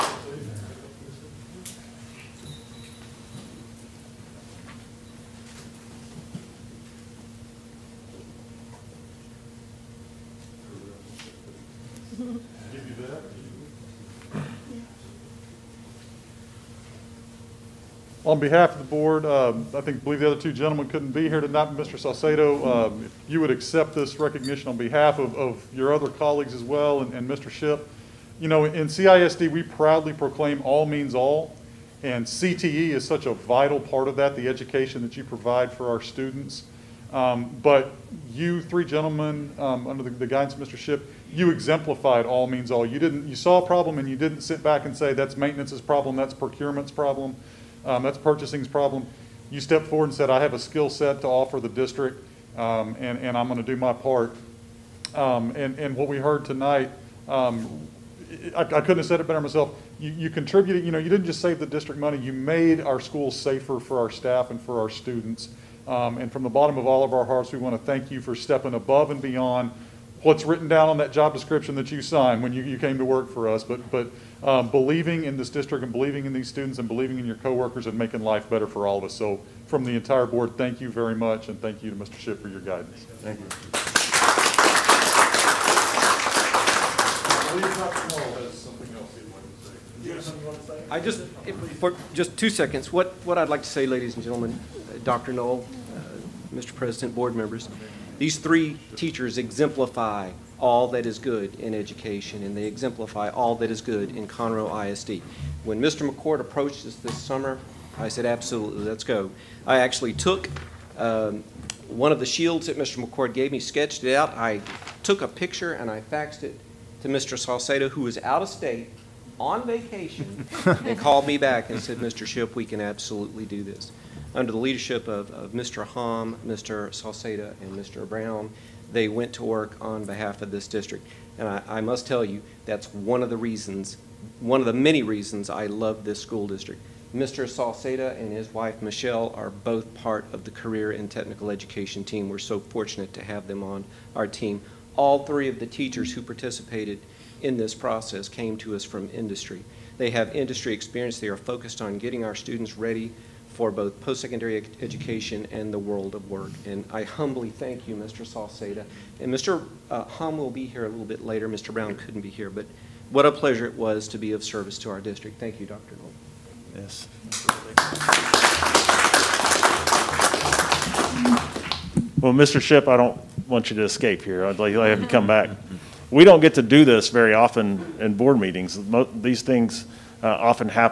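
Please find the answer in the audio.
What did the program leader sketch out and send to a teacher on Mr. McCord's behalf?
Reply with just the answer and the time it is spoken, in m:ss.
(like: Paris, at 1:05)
Shields, at 1:52.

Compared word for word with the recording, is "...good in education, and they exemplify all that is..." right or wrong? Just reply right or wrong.
right.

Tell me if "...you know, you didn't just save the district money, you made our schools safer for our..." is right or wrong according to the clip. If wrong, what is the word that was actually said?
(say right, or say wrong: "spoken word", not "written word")
right.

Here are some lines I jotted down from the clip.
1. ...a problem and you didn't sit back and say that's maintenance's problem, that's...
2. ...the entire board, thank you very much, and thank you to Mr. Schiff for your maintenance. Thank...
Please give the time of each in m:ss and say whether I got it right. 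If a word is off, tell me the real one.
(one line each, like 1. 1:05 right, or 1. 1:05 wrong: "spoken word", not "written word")
1. 0:43 right
2. 1:19 wrong: "guidance", not "maintenance".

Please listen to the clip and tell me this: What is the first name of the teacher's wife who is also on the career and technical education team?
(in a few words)
Michelle.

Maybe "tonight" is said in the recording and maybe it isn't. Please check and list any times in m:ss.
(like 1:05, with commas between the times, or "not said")
0:21, 0:56.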